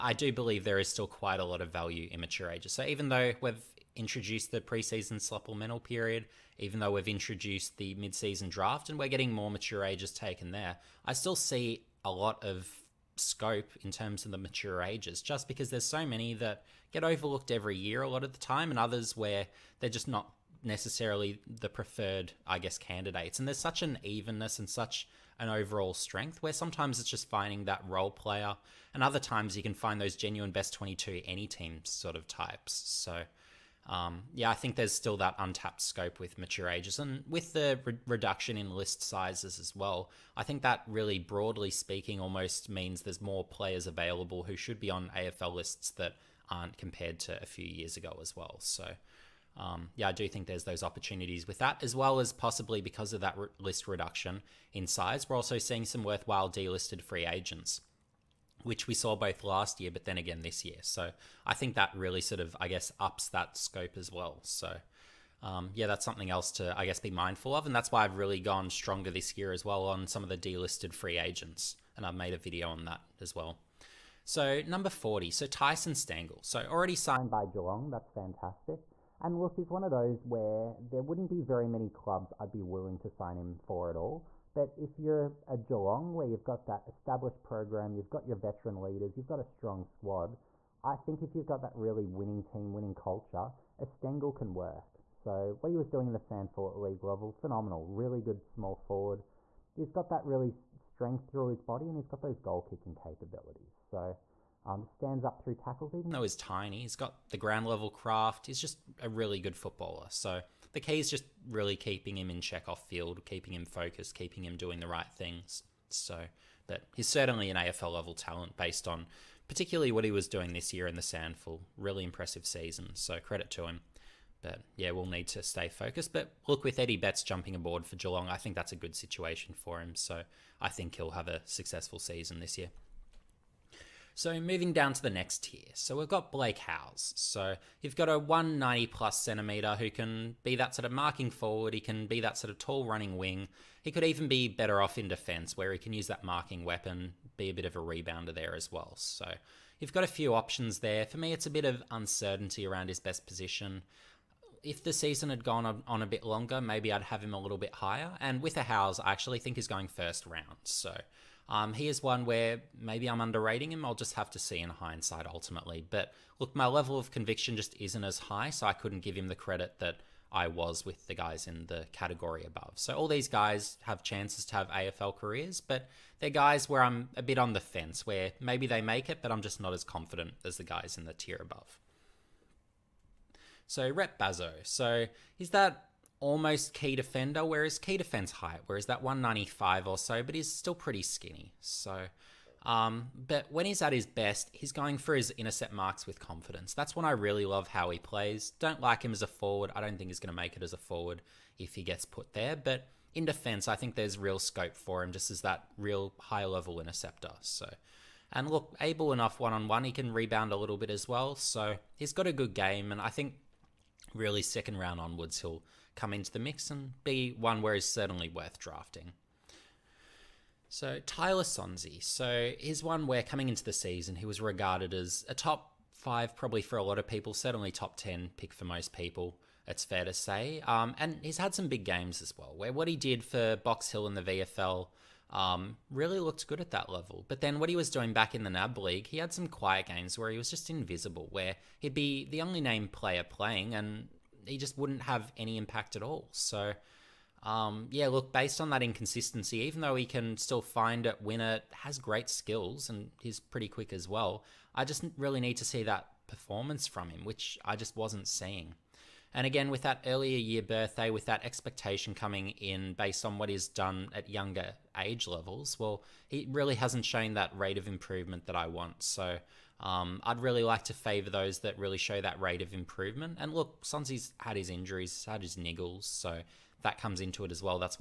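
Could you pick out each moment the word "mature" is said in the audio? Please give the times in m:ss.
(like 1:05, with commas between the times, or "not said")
0:02, 0:09, 0:14, 0:36.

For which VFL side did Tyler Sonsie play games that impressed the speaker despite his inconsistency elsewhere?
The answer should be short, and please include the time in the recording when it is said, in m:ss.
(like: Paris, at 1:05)
Box Hill, at 3:53.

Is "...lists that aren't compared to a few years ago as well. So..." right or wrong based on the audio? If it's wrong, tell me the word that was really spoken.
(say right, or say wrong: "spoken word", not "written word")
right.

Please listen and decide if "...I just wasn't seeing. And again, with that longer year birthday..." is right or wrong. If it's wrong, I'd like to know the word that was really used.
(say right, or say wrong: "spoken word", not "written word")
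wrong: "earlier", not "longer".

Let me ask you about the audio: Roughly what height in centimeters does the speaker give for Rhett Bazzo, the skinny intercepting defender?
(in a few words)
195.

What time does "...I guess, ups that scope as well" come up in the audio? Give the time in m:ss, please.
1:02.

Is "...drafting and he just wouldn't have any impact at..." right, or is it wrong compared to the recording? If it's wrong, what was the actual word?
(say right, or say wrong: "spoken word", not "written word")
wrong: "playing", not "drafting".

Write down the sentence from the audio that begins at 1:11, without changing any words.
And I've made a video on that as well.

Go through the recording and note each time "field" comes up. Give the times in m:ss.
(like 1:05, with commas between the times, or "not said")
1:52.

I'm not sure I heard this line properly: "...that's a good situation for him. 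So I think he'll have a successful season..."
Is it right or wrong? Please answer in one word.
right.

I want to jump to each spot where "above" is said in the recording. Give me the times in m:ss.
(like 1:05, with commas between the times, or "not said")
2:52, 3:01.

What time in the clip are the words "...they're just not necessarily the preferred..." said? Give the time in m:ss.
0:19.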